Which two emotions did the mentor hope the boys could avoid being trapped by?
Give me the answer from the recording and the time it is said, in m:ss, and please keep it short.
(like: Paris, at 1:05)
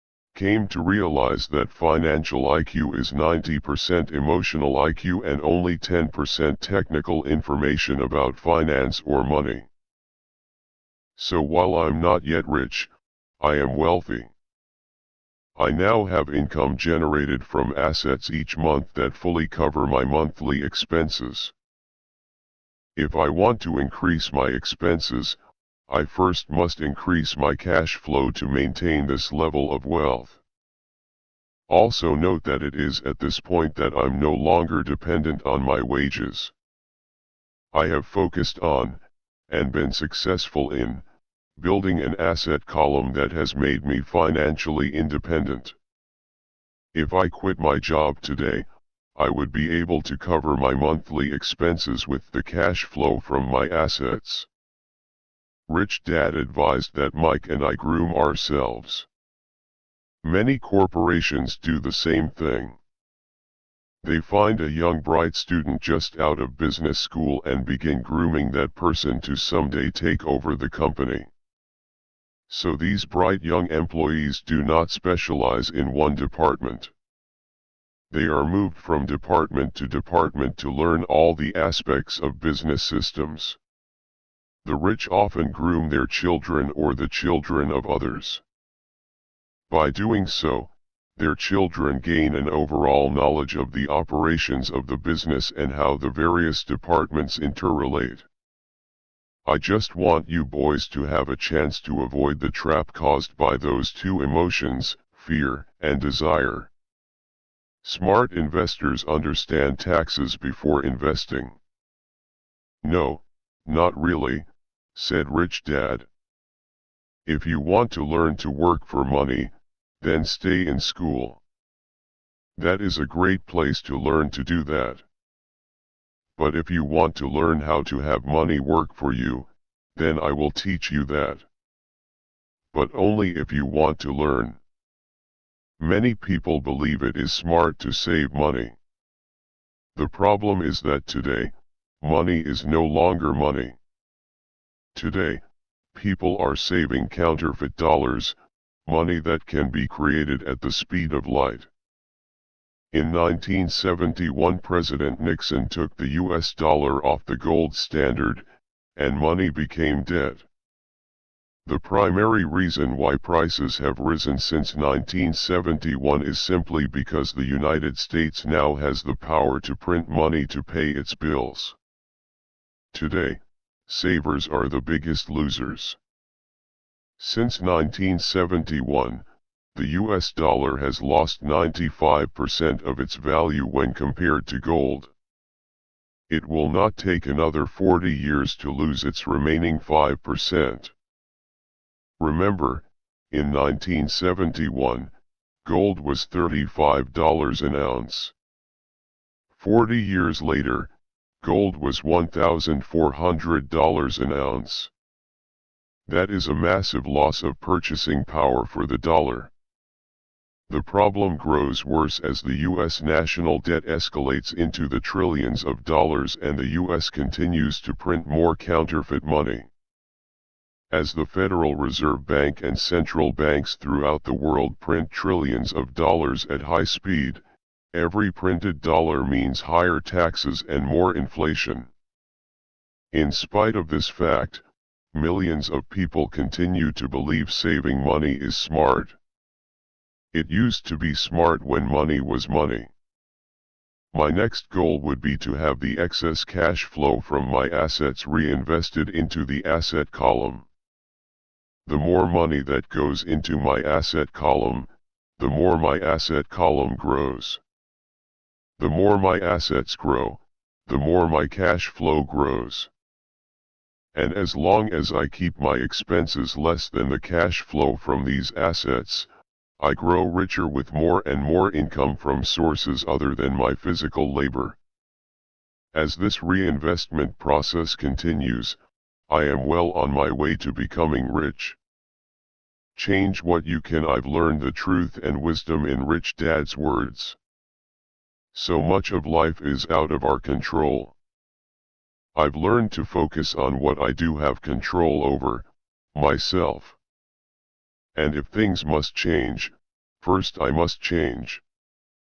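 Fear and desire, at 1:45.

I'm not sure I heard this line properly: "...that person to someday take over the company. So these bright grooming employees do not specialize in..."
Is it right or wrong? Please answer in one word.
wrong.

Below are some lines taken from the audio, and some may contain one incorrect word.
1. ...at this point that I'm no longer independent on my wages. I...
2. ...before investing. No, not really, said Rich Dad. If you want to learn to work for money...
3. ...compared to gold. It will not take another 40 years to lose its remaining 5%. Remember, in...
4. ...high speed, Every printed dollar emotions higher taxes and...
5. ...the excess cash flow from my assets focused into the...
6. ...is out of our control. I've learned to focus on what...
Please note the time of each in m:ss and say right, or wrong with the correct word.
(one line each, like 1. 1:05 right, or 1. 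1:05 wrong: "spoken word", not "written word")
1. 0:33 wrong: "dependent", not "independent"
2. 1:50 right
3. 3:03 right
4. 3:46 wrong: "means", not "emotions"
5. 4:05 wrong: "reinvested", not "focused"
6. 4:49 right.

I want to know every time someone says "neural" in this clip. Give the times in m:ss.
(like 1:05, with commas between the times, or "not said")
not said.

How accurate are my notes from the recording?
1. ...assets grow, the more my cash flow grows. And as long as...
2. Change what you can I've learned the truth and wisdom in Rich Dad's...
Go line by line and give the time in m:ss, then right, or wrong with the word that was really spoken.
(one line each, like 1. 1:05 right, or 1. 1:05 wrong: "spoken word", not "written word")
1. 4:19 right
2. 4:42 right.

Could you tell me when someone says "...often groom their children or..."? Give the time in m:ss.
1:25.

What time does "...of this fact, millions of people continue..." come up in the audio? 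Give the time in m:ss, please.
3:53.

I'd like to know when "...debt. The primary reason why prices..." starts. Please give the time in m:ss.
2:40.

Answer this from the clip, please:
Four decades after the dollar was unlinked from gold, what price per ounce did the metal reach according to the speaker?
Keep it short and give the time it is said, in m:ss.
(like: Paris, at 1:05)
$1,400, at 3:22.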